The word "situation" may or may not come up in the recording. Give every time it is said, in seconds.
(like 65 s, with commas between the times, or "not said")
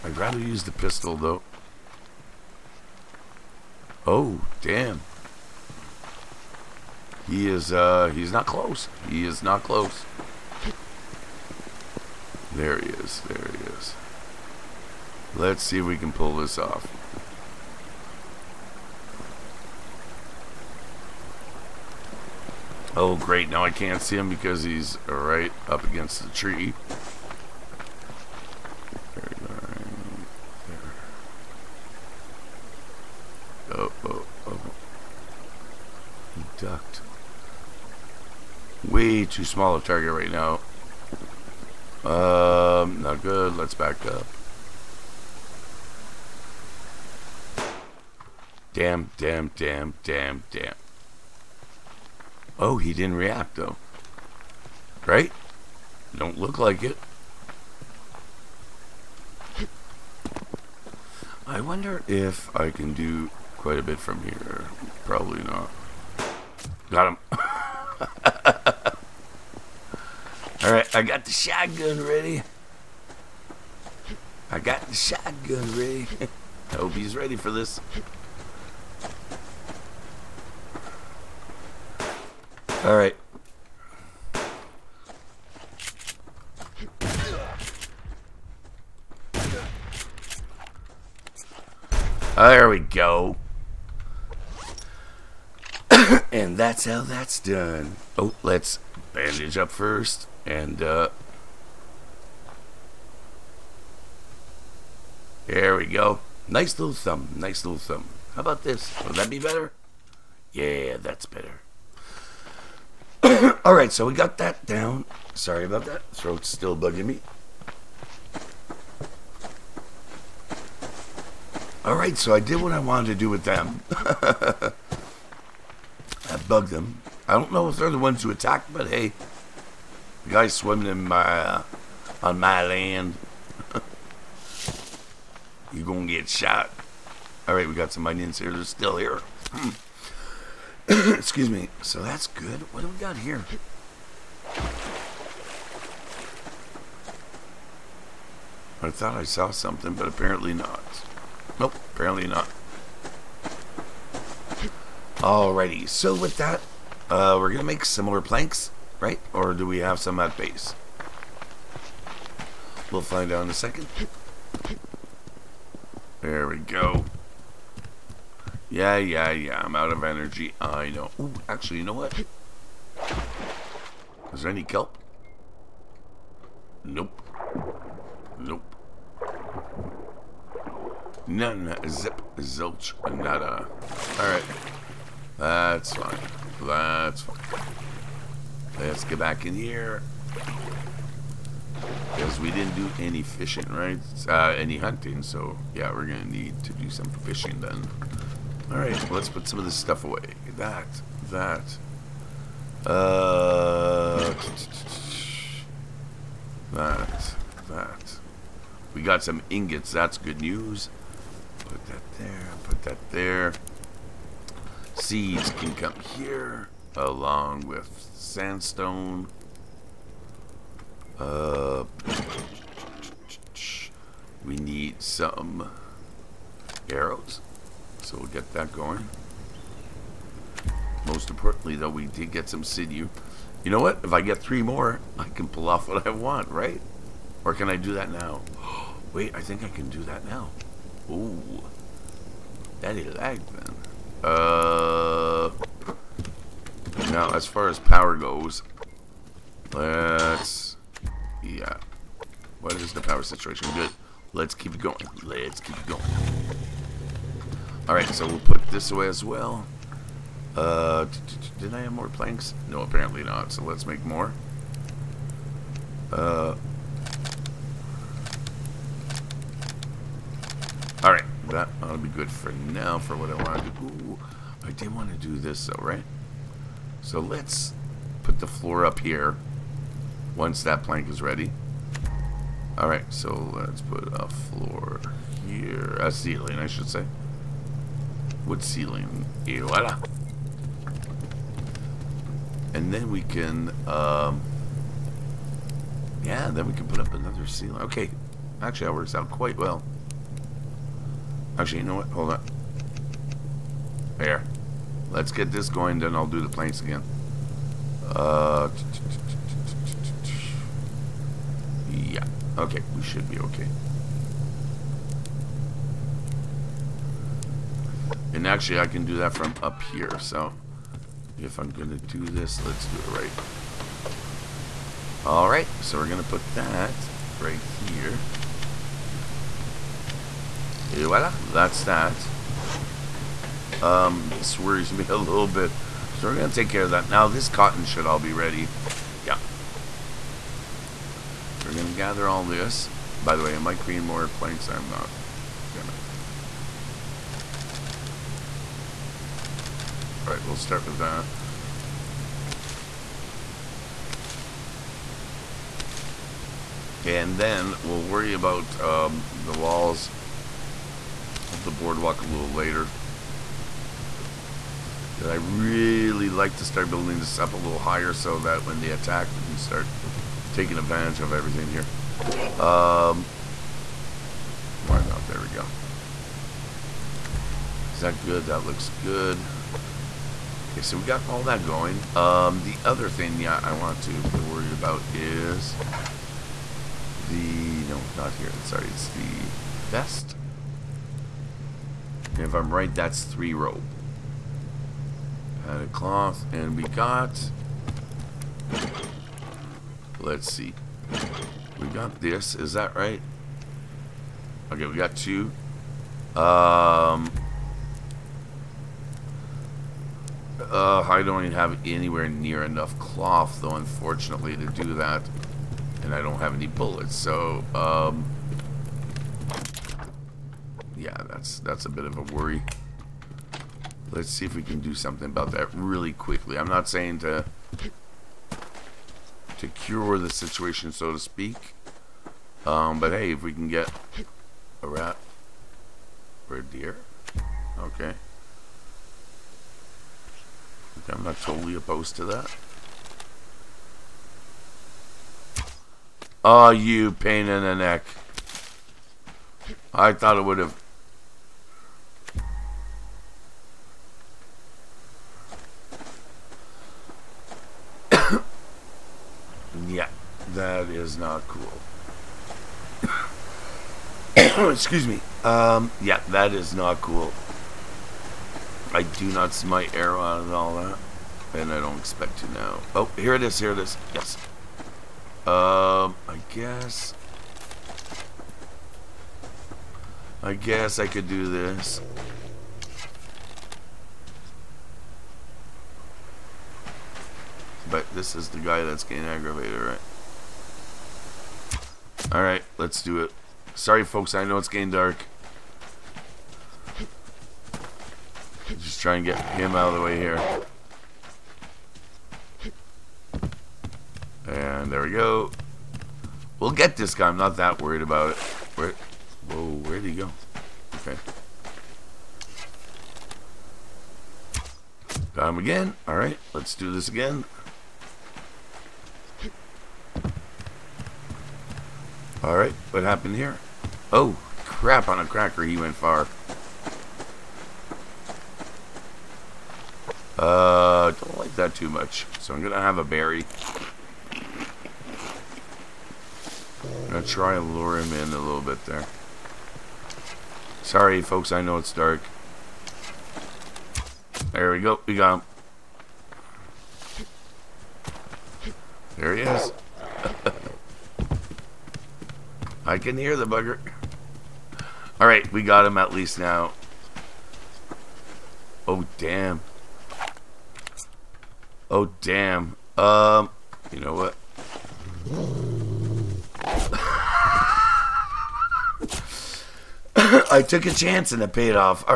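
253 s, 430 s.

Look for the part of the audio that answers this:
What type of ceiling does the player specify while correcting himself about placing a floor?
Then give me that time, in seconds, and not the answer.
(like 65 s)
288 s.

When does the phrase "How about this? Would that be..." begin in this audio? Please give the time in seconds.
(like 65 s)
108 s.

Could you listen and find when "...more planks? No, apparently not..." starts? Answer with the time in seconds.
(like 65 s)
261 s.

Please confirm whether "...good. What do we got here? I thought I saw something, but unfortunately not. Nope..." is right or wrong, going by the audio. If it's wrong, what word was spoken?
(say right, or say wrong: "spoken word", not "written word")
wrong: "apparently", not "unfortunately".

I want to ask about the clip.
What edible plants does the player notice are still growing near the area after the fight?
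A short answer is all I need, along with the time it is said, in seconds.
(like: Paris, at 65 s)
onions, at 138 s.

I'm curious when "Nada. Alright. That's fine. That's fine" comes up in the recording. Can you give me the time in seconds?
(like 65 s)
183 s.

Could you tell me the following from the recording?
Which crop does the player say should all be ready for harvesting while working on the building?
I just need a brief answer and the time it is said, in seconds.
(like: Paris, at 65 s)
cotton, at 337 s.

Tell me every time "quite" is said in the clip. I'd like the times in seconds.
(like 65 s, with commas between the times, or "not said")
63 s, 299 s.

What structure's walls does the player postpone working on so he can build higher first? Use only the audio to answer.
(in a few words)
boardwalk.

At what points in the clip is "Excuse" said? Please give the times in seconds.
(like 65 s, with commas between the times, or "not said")
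140 s, 464 s.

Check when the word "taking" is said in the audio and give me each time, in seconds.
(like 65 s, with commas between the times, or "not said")
370 s.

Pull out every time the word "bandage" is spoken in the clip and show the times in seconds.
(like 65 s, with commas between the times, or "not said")
99 s.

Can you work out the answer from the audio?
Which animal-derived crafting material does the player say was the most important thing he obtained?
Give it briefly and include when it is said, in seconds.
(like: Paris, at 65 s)
sinew, at 232 s.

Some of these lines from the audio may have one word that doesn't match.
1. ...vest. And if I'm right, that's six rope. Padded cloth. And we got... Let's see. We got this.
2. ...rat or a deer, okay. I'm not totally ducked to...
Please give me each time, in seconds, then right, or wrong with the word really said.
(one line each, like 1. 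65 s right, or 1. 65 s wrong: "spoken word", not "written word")
1. 389 s wrong: "three", not "six"
2. 434 s wrong: "opposed", not "ducked".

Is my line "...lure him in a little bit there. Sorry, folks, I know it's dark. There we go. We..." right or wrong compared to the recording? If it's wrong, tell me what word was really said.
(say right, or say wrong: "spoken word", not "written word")
right.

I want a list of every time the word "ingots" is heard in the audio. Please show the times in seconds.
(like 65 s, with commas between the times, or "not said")
209 s.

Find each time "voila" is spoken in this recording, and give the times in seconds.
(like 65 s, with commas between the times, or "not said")
289 s, 331 s.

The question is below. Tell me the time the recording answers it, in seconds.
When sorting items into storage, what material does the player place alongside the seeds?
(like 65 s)
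218 s.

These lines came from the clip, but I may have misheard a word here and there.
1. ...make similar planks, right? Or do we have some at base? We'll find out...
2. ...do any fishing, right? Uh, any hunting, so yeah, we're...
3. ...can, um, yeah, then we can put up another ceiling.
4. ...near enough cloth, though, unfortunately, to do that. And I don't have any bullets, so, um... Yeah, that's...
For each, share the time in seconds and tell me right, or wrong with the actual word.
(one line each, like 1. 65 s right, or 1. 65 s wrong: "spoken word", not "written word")
1. 157 s right
2. 192 s right
3. 293 s right
4. 412 s right.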